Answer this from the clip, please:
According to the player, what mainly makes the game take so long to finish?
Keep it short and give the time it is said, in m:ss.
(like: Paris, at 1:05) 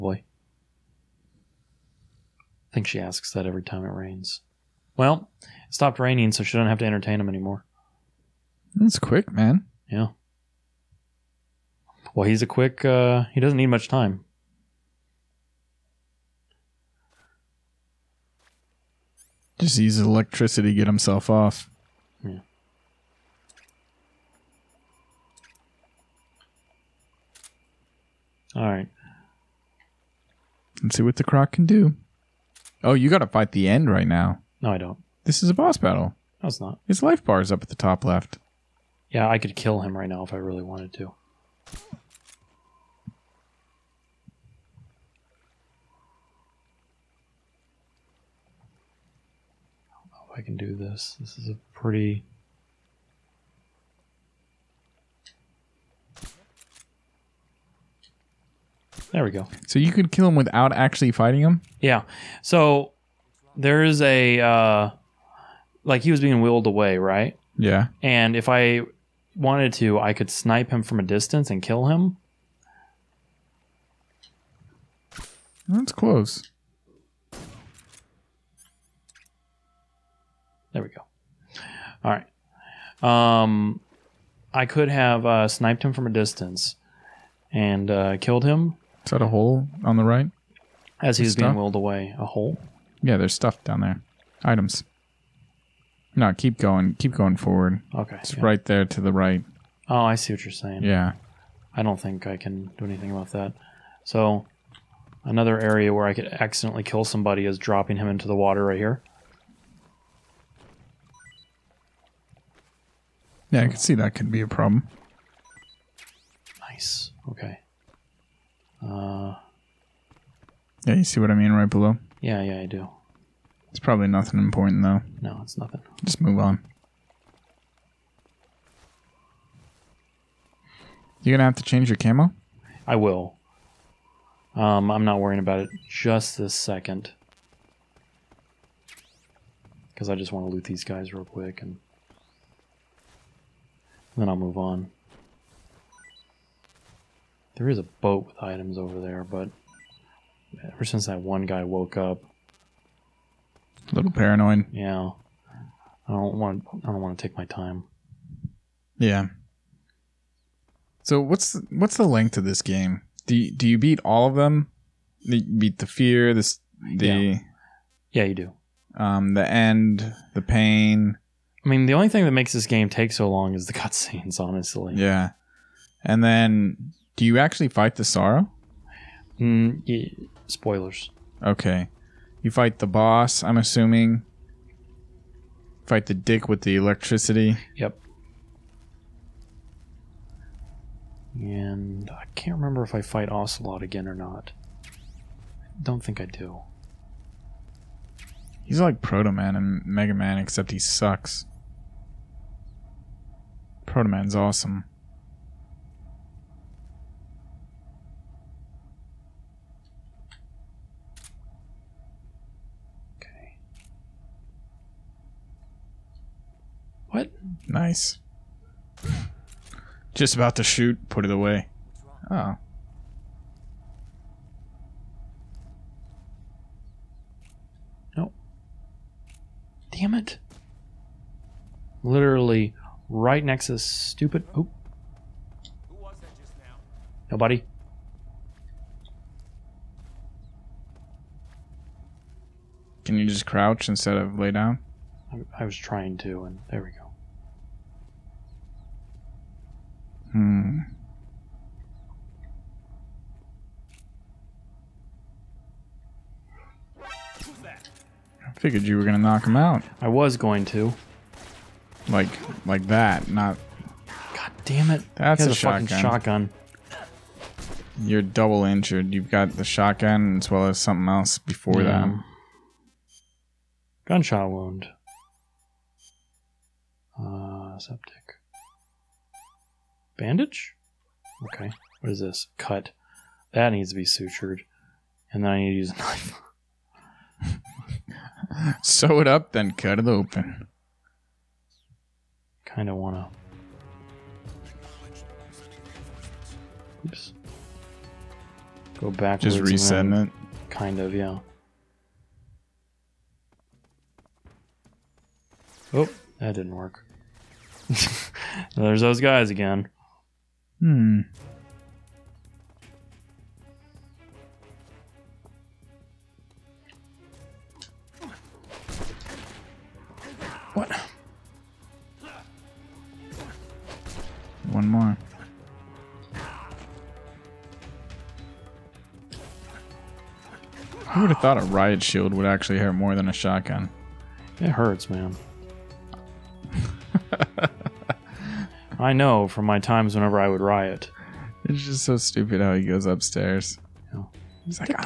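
cutscenes, at 2:53.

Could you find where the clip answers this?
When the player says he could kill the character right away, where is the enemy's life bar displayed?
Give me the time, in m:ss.
0:37.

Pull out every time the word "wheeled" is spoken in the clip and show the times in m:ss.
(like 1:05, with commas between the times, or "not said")
1:06, 1:31.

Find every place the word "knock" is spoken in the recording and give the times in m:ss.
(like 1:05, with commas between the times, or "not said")
4:19.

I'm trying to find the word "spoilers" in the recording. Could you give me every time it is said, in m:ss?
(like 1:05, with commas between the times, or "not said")
3:00.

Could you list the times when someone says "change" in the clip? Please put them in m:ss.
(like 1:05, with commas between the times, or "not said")
2:11.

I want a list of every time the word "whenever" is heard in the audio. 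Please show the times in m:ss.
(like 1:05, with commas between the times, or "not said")
5:40.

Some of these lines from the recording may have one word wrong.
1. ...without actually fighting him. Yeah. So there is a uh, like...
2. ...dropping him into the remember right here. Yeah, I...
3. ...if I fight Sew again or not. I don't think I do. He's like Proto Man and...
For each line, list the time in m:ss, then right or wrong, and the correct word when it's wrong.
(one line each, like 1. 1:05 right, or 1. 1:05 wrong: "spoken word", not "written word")
1. 1:00 right
2. 1:47 wrong: "water", not "remember"
3. 3:12 wrong: "Ocelot", not "Sew".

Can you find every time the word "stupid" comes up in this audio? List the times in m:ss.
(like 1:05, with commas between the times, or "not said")
3:53, 5:42.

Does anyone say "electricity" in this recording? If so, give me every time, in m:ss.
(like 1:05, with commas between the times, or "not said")
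0:19, 3:06.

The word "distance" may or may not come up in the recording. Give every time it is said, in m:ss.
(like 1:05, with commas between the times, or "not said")
1:11, 1:26.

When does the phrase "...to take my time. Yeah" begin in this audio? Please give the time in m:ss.
2:37.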